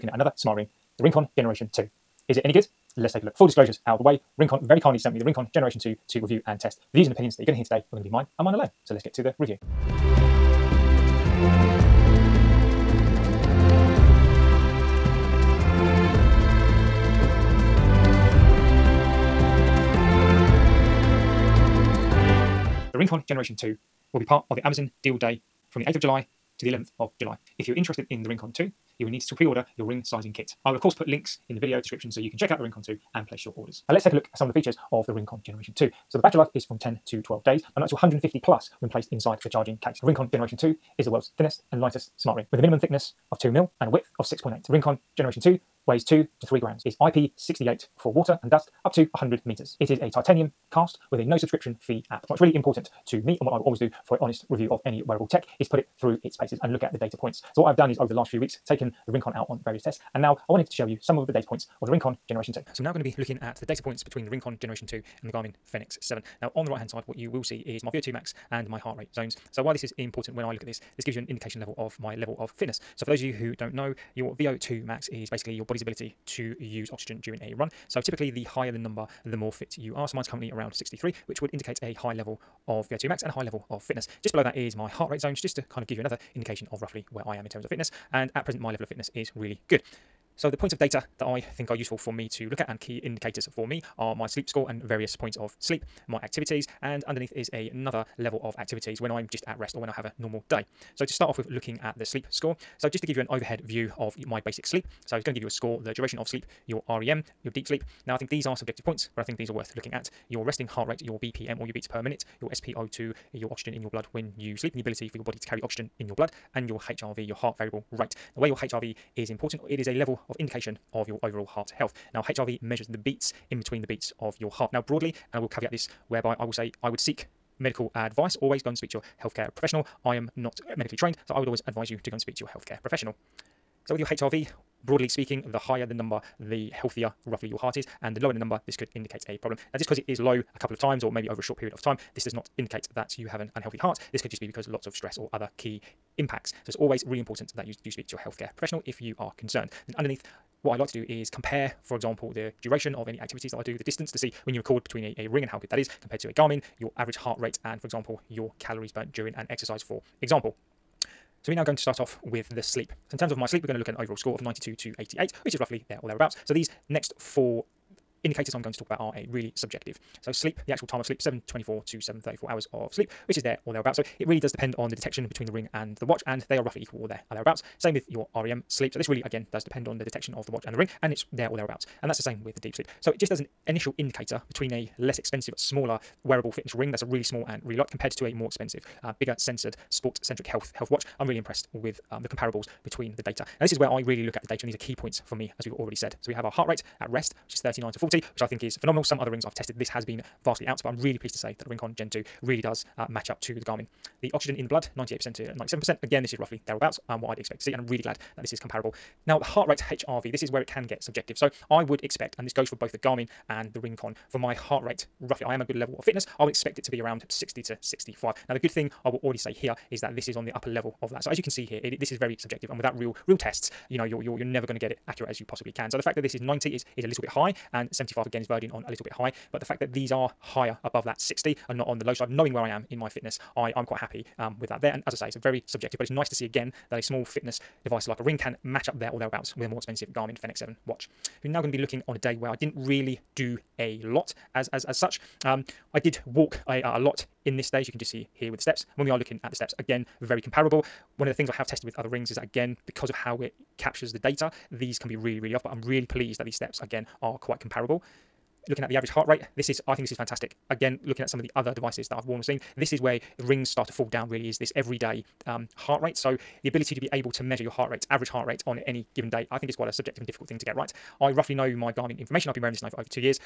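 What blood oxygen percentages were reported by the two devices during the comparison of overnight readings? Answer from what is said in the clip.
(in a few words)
98% to 97%.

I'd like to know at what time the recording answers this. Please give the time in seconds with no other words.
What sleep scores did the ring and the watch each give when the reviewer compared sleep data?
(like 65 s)
164 s.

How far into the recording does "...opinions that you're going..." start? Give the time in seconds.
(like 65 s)
7 s.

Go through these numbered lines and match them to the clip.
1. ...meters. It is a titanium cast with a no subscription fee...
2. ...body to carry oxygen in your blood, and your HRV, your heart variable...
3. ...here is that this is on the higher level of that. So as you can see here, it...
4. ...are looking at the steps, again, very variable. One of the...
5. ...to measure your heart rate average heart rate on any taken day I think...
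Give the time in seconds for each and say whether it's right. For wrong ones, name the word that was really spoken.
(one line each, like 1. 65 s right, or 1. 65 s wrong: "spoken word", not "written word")
1. 49 s right
2. 115 s right
3. 219 s wrong: "upper", not "higher"
4. 249 s wrong: "comparable", not "variable"
5. 267 s wrong: "given", not "taken".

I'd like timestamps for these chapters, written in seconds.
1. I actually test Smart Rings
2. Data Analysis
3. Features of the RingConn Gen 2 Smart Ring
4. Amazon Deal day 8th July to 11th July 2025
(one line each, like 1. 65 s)
1. 52 s
2. 62 s
3. 33 s
4. 22 s.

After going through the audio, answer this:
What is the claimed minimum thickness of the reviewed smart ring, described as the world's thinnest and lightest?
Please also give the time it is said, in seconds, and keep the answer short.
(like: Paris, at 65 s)
2 mil, at 43 s.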